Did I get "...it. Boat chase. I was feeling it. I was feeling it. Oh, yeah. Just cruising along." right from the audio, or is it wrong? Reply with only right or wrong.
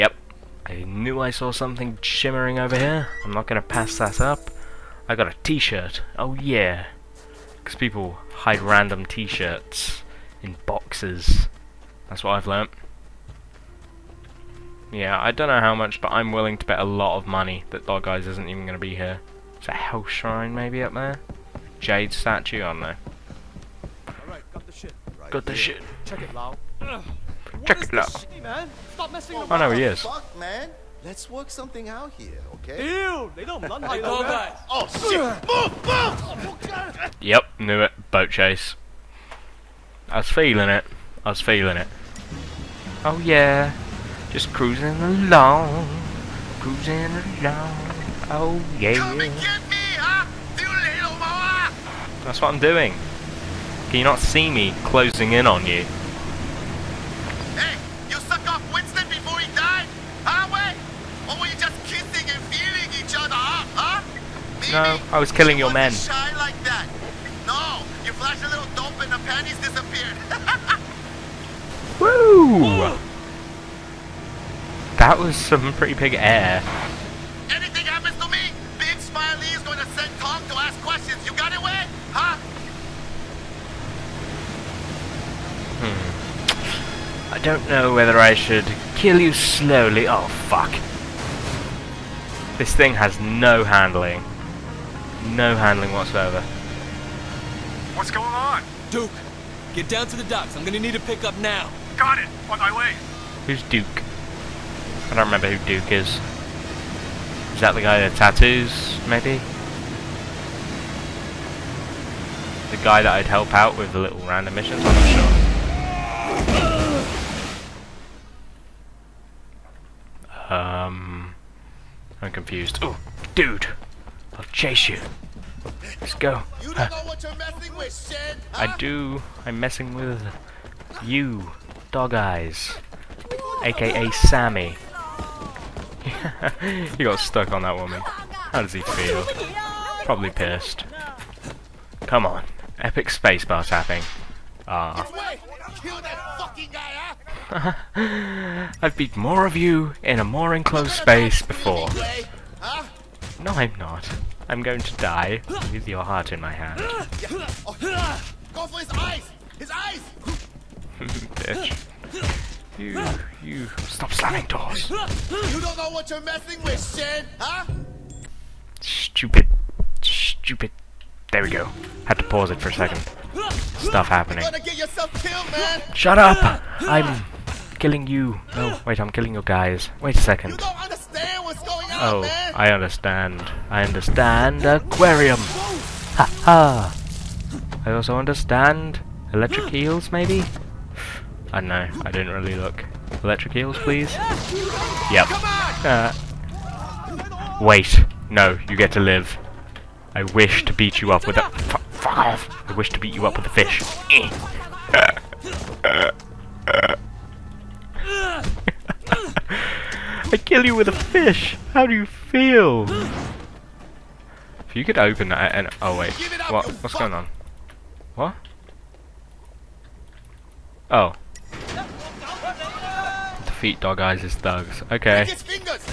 right.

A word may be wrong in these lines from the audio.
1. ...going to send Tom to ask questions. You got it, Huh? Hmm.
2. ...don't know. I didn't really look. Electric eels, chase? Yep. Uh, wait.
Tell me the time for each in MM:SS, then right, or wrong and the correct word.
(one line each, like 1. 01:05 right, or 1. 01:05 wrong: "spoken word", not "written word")
1. 01:19 right
2. 03:11 wrong: "please", not "chase".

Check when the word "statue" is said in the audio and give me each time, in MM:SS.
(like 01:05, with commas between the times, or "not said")
00:22.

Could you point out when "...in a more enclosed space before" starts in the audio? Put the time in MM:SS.
02:30.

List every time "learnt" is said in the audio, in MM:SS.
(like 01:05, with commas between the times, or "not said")
00:12.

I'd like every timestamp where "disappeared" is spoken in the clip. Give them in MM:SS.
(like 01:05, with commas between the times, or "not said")
01:09.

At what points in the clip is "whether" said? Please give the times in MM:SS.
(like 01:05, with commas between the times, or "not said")
01:27.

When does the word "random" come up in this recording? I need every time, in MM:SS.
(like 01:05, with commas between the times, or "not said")
00:08, 01:54.